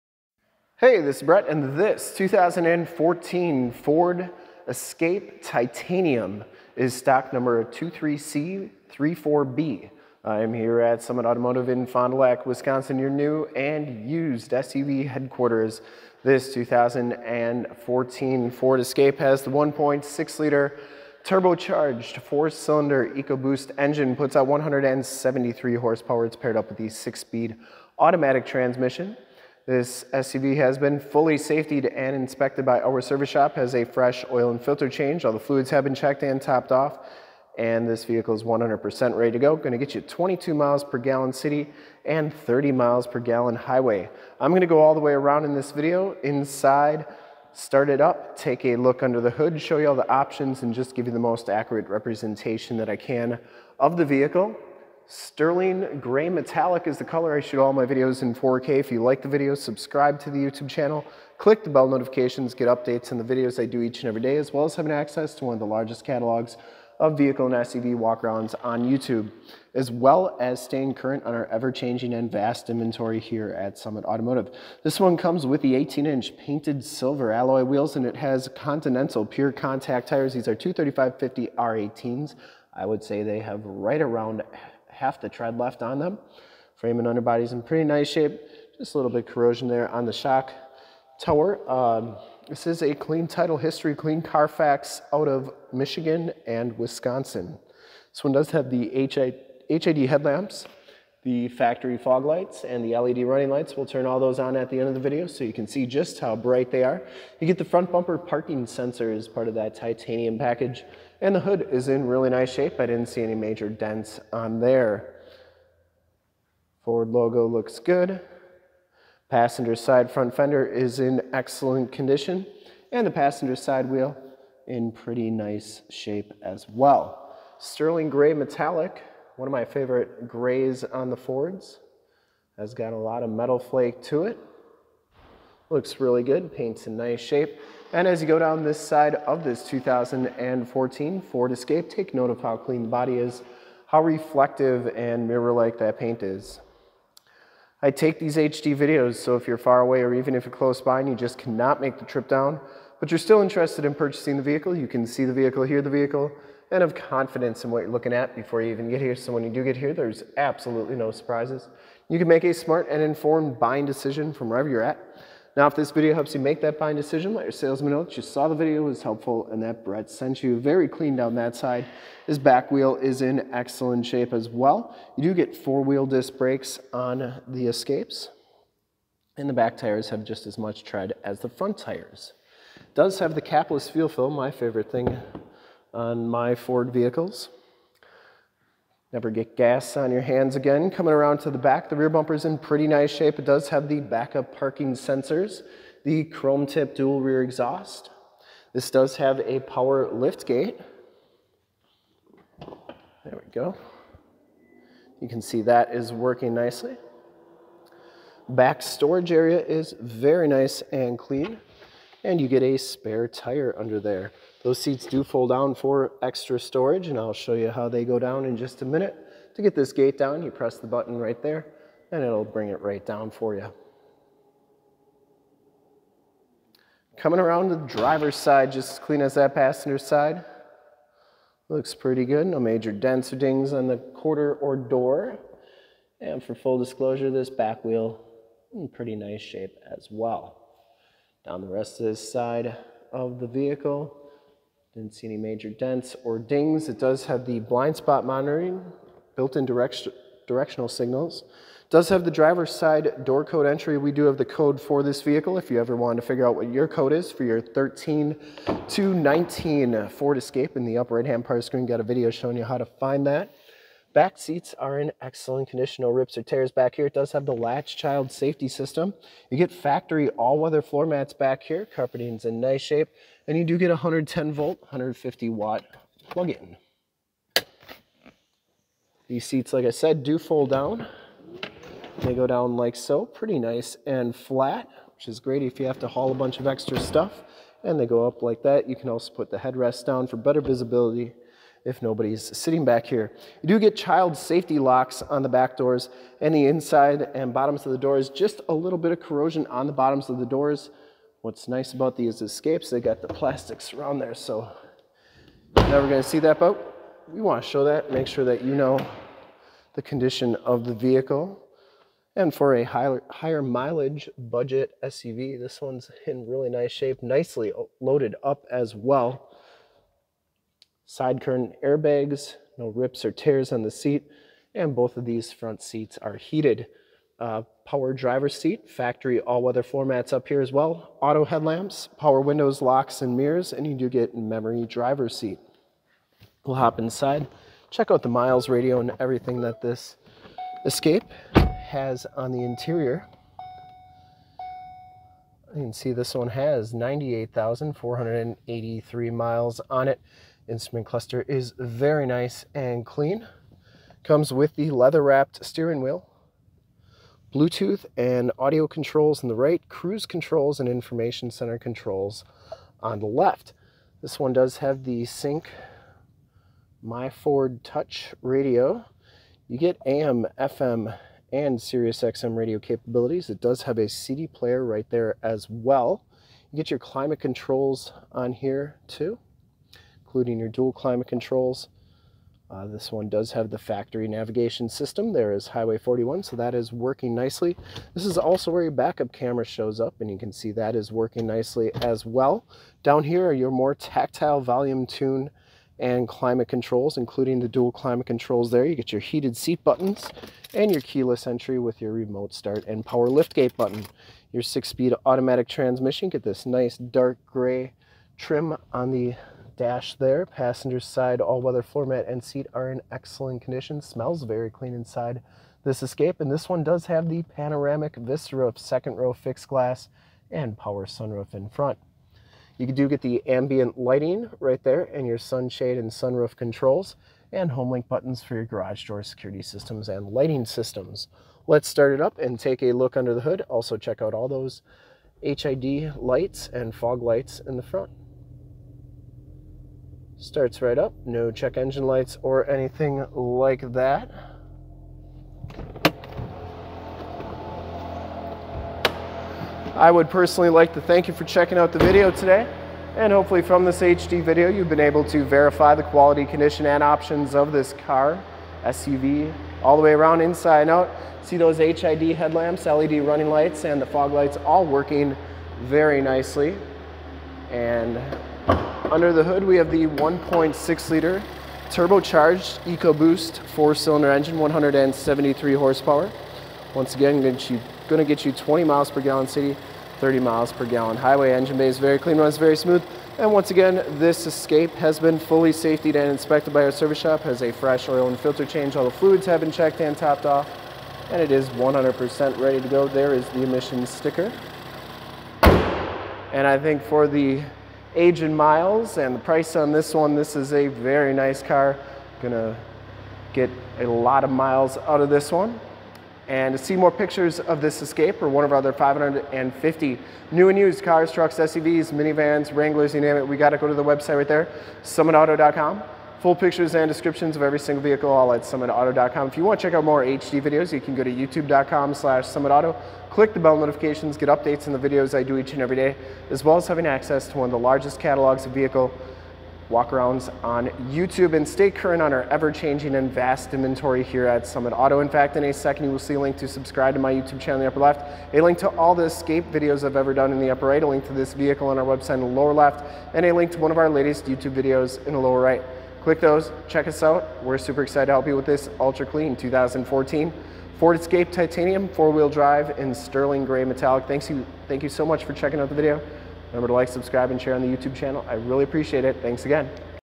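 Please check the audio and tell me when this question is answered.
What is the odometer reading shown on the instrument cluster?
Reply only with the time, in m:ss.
5:46.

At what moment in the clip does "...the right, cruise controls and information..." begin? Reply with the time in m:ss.
5:59.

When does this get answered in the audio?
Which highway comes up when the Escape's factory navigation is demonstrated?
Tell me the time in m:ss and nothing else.
6:25.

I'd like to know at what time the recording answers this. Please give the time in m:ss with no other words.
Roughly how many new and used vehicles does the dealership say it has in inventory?
8:28.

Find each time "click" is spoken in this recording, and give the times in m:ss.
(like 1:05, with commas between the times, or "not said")
1:01, 8:43, 9:06.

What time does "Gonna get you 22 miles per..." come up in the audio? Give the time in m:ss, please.
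0:39.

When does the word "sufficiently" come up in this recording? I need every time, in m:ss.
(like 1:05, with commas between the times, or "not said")
not said.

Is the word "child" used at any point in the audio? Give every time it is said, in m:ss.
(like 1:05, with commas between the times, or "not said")
4:27, 4:53.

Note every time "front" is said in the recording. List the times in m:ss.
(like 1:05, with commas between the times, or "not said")
1:47, 2:00, 3:01, 5:25, 7:01, 7:17.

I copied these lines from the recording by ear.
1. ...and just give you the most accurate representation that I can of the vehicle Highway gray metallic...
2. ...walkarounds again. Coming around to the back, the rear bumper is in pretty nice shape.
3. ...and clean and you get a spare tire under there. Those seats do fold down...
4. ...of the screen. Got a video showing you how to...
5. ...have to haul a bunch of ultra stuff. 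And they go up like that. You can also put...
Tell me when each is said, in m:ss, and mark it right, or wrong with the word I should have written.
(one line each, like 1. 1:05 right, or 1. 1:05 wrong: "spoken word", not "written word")
1. 0:50 wrong: "Sterling", not "Highway"
2. 3:10 wrong: "hands", not "walkarounds"
3. 3:30 right
4. 4:21 right
5. 4:45 wrong: "extra", not "ultra".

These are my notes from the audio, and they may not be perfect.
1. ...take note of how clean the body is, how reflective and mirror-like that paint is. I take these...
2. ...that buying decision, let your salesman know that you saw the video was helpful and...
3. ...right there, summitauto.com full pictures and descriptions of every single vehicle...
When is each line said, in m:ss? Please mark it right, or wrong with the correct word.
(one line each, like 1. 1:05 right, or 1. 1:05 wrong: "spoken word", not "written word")
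1. 2:21 right
2. 2:46 right
3. 8:34 right.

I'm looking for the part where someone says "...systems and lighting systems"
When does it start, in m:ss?
7:09.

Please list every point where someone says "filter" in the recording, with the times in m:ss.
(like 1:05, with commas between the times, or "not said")
0:34, 8:08.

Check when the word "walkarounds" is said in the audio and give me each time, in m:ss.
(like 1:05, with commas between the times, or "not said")
1:07, 8:49.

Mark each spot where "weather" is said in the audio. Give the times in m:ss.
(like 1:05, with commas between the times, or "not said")
4:30, 5:29, 6:51.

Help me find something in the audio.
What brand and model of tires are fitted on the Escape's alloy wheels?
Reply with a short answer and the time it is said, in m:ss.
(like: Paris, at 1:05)
Continental Pure Contact, at 1:18.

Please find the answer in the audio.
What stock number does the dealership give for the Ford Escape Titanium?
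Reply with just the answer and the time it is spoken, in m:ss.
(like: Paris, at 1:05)
23C34B, at 0:07.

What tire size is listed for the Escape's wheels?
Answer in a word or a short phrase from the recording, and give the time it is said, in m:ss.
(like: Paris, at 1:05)
235/50 R18, at 1:20.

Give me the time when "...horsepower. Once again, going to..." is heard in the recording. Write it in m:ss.
7:55.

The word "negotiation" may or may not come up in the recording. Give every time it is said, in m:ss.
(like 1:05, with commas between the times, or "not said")
not said.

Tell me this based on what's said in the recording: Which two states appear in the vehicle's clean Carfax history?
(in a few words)
Michigan and Wisconsin.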